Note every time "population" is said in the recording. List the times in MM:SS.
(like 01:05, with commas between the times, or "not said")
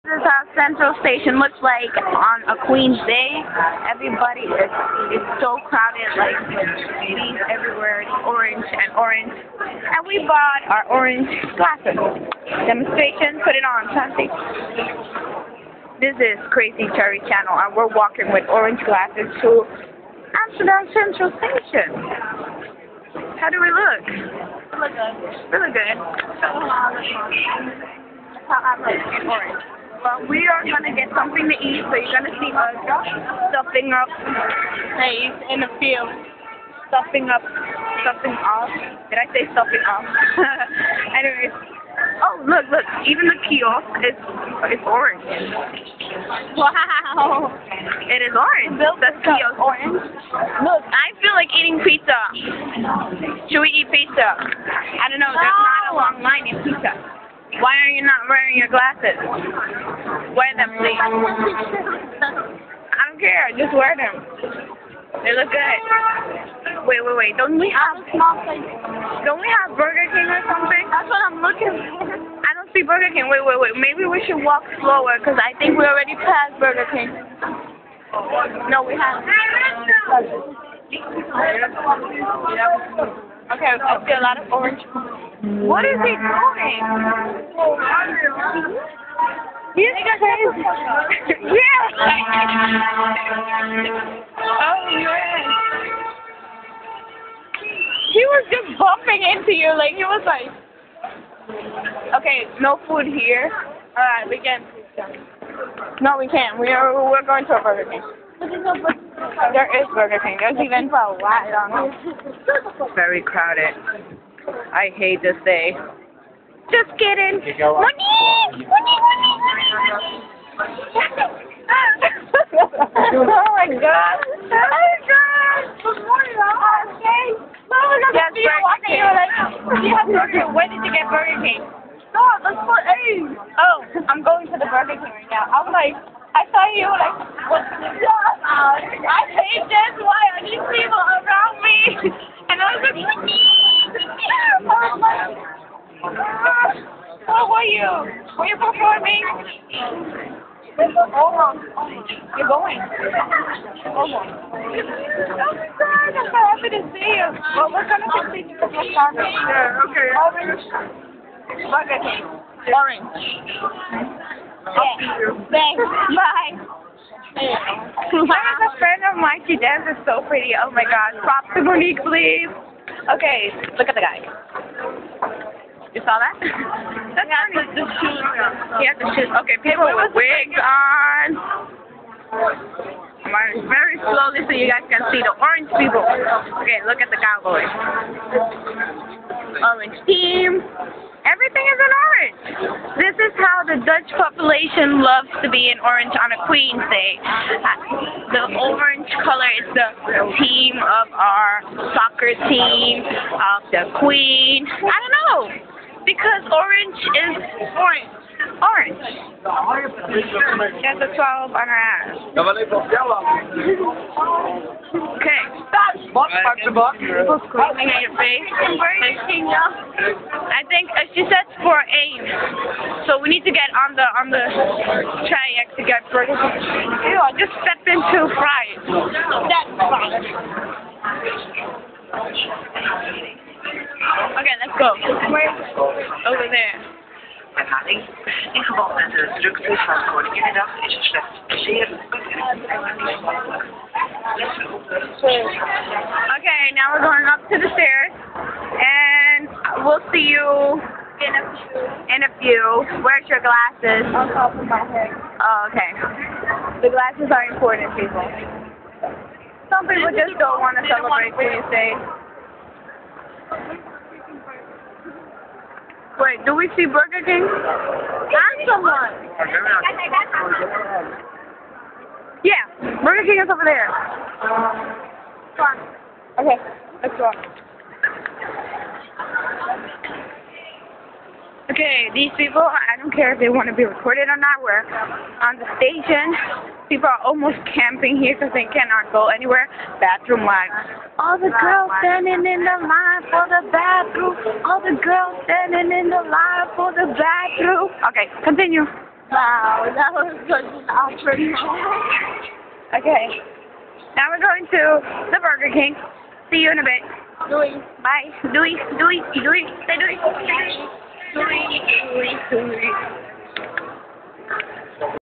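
03:14.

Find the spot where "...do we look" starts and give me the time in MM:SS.
00:23.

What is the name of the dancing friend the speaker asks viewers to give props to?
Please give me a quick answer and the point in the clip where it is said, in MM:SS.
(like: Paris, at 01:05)
Monique, at 02:51.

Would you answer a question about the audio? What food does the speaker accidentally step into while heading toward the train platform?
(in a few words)
fries.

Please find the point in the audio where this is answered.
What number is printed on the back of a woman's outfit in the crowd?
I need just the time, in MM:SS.
03:31.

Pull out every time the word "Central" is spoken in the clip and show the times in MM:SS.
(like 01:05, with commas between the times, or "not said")
00:00, 00:20.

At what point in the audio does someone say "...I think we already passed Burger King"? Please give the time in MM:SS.
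01:15.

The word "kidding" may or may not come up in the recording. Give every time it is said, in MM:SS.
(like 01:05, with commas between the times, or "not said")
01:56.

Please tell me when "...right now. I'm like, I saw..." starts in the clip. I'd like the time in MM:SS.
02:15.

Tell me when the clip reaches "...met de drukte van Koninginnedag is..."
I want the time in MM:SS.
03:58.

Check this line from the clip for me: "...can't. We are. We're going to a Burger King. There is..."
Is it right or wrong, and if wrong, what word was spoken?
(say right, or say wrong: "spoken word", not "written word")
right.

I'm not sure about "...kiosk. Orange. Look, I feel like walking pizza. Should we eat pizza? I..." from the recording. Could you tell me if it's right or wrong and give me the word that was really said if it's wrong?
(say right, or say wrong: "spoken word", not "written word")
wrong: "eating", not "walking".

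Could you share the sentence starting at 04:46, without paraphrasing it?
People are almost camping here because they cannot go anywhere.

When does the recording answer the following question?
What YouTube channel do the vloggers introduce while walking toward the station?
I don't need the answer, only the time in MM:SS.
00:16.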